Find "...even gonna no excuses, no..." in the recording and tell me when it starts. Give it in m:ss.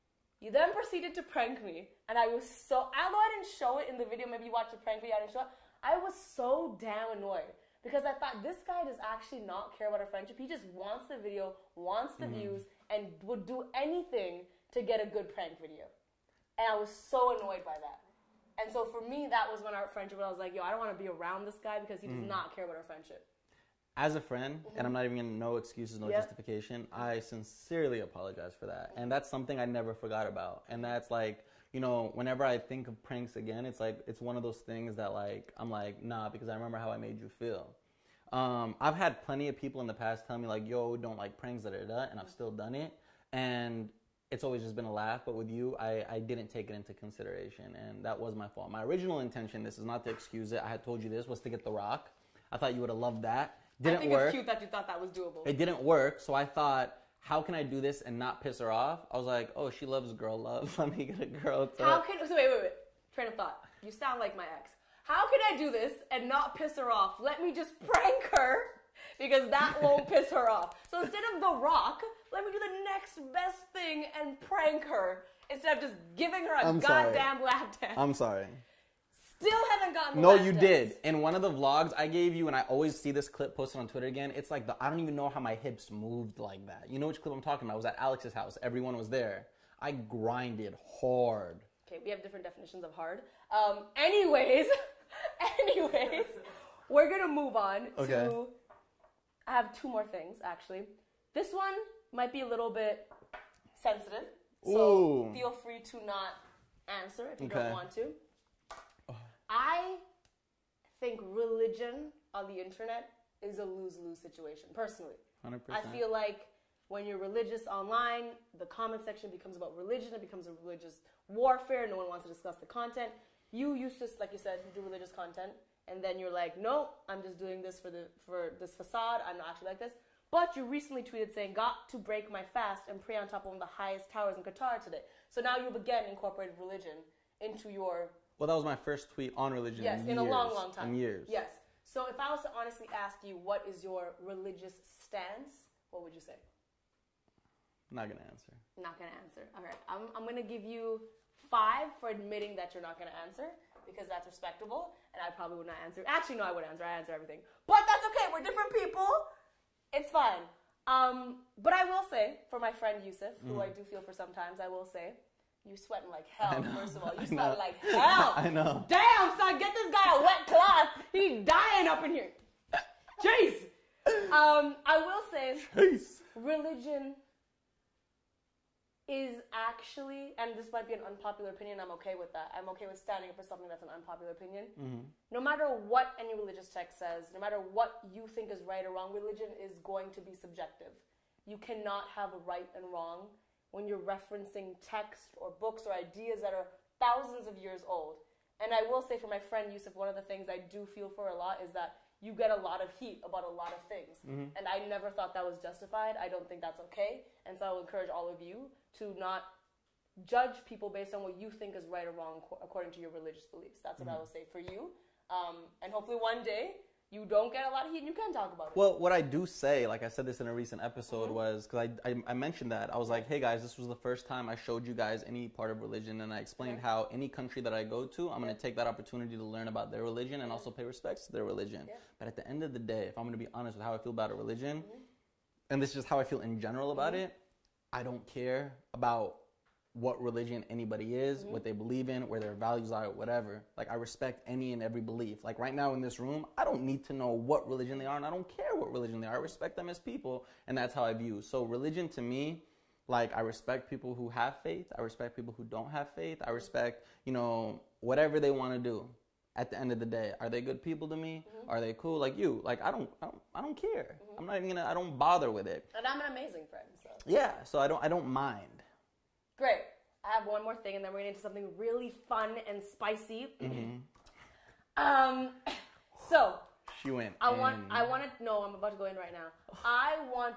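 0:25.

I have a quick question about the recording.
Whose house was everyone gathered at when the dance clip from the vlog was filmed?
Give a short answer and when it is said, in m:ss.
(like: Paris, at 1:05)
Alex's house, at 1:27.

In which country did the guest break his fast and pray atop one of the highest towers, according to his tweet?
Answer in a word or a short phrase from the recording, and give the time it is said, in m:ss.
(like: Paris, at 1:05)
Qatar, at 2:14.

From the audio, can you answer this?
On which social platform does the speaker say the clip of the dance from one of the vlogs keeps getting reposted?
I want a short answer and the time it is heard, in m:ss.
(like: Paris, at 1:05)
Twitter, at 1:23.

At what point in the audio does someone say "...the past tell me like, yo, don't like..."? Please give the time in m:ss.
0:39.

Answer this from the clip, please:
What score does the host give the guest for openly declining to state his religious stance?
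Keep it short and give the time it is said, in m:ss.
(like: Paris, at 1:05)
5, at 2:31.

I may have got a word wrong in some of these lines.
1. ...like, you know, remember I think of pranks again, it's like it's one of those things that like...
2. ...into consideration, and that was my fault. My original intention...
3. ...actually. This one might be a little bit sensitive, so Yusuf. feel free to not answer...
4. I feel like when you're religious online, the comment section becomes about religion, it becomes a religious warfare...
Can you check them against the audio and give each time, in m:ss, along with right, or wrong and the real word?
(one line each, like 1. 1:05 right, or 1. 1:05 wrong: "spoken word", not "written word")
1. 0:31 wrong: "whenever", not "remember"
2. 0:46 right
3. 1:40 wrong: "Ooh", not "Yusuf"
4. 1:55 right.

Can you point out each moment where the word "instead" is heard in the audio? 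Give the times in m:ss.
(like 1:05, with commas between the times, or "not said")
1:11, 1:15.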